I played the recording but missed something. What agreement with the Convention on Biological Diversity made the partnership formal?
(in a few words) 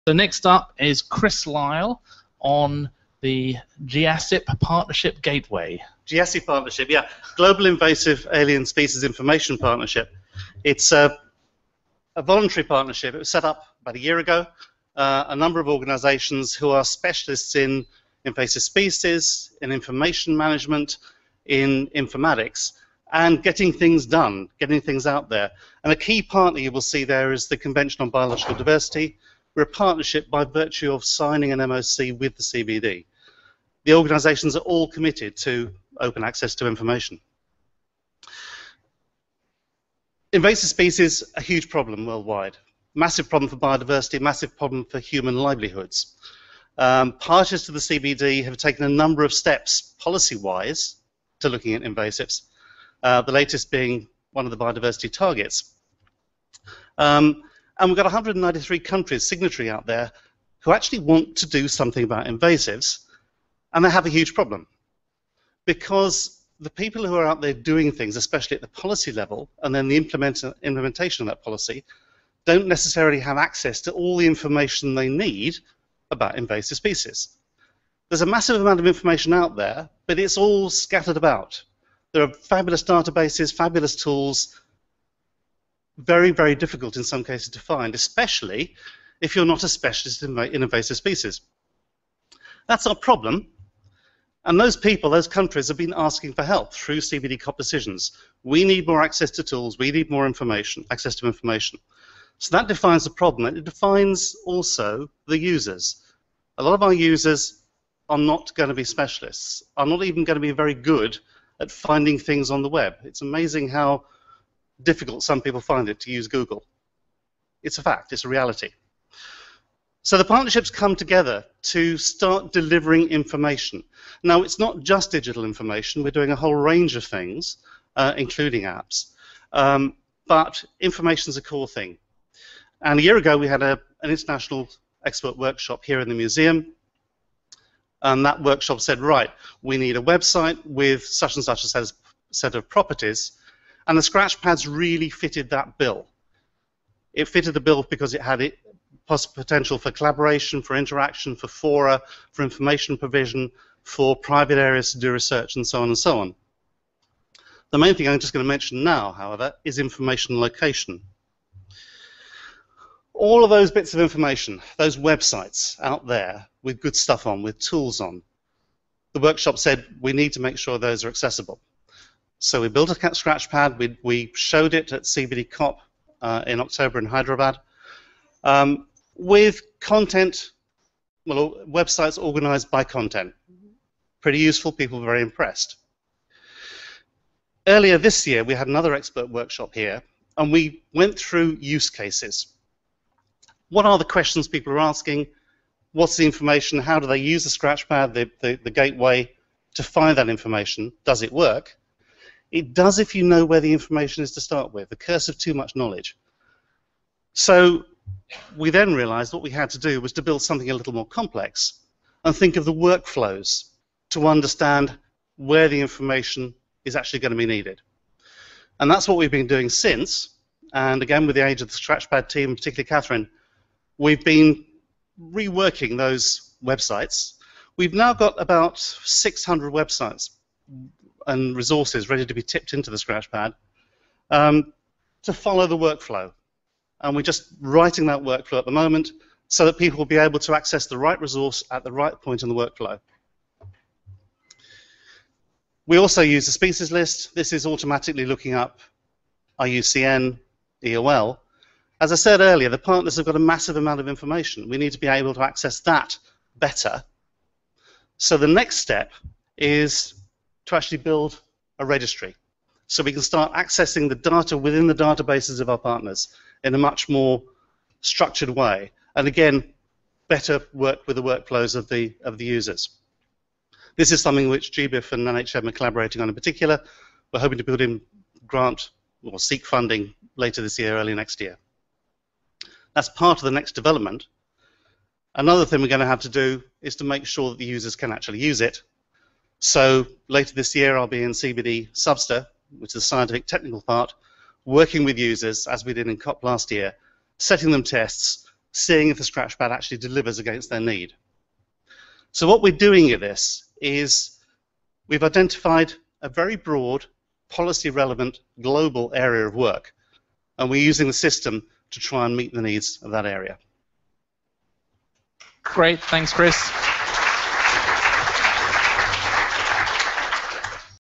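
MOC.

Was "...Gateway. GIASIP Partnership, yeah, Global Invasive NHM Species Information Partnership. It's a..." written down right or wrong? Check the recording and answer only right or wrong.
wrong.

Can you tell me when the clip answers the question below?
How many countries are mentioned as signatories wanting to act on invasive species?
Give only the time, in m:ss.
0:58.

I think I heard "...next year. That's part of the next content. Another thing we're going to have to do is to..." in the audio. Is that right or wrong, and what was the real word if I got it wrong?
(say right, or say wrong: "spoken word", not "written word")
wrong: "development", not "content".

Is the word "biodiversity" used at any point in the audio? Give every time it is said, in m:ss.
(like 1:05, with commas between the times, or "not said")
0:43, 0:54.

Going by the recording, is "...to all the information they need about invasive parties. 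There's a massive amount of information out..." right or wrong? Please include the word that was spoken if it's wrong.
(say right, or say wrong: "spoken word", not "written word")
wrong: "species", not "parties".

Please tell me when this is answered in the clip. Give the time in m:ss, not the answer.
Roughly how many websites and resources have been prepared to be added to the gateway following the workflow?
3:48.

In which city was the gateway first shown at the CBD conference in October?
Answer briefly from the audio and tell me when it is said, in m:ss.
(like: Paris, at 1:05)
Hyderabad, at 2:57.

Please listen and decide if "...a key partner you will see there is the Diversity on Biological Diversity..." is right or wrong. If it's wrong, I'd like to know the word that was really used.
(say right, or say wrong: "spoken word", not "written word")
wrong: "Convention", not "Diversity".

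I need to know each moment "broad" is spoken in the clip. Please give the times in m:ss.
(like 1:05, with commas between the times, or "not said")
5:06.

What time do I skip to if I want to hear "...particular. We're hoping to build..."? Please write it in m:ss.
4:36.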